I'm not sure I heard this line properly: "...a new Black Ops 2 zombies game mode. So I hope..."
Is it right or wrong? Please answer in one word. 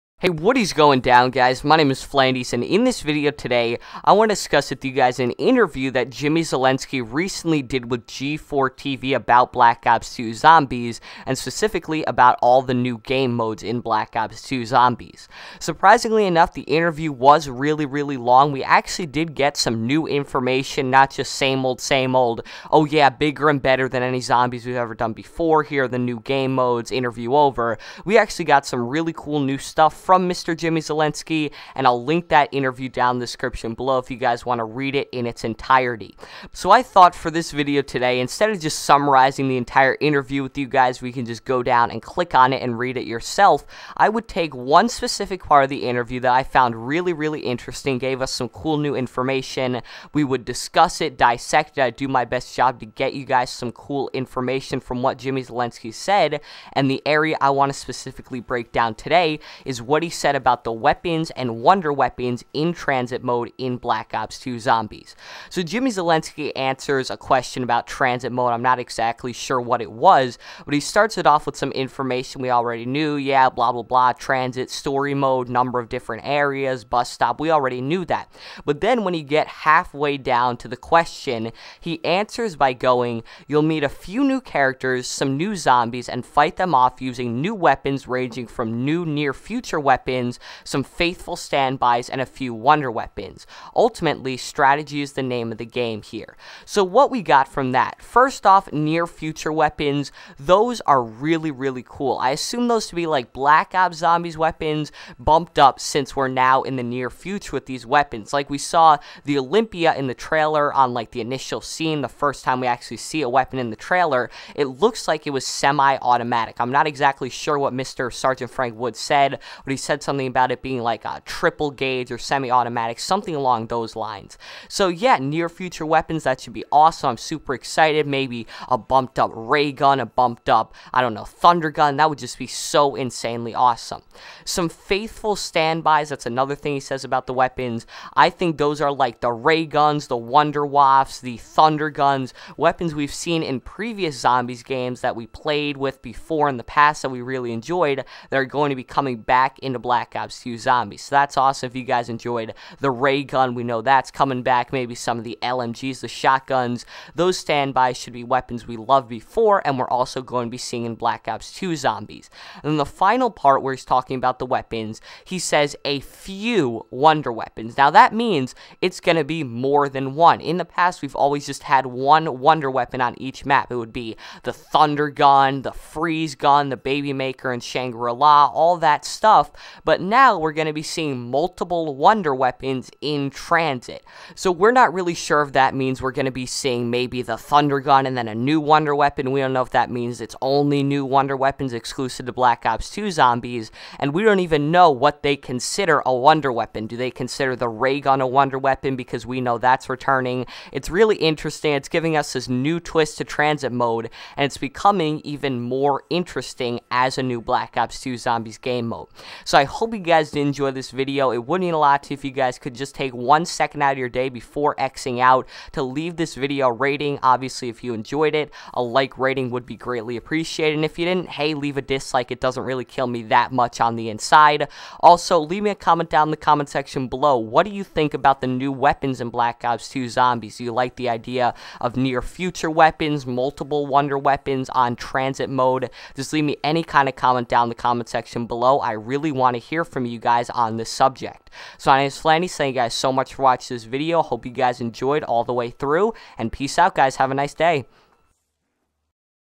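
right.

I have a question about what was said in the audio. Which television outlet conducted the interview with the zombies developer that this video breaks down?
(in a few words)
G4 TV.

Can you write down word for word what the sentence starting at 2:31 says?
So that's awesome if you guys enjoyed the ray gun.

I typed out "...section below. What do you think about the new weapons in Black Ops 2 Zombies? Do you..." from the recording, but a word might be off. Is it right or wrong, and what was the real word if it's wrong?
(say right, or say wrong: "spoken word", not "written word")
right.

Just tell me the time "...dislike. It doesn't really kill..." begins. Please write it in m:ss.
3:41.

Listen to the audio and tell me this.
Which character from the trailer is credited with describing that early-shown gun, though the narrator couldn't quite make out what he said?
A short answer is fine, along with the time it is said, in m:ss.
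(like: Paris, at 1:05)
Frank Wood, at 1:58.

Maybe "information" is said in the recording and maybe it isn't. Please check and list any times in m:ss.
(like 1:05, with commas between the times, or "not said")
0:20, 0:48, 0:54, 1:11.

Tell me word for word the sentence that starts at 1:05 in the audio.
So Jimmy Zielinski answers a question about transit mode.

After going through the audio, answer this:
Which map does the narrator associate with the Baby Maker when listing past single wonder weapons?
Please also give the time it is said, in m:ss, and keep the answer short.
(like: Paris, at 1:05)
Shangri-La, at 2:57.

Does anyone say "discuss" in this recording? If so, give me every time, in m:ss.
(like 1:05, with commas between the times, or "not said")
0:04, 0:50.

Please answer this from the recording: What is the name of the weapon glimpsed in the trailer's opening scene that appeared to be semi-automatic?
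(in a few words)
Olympia.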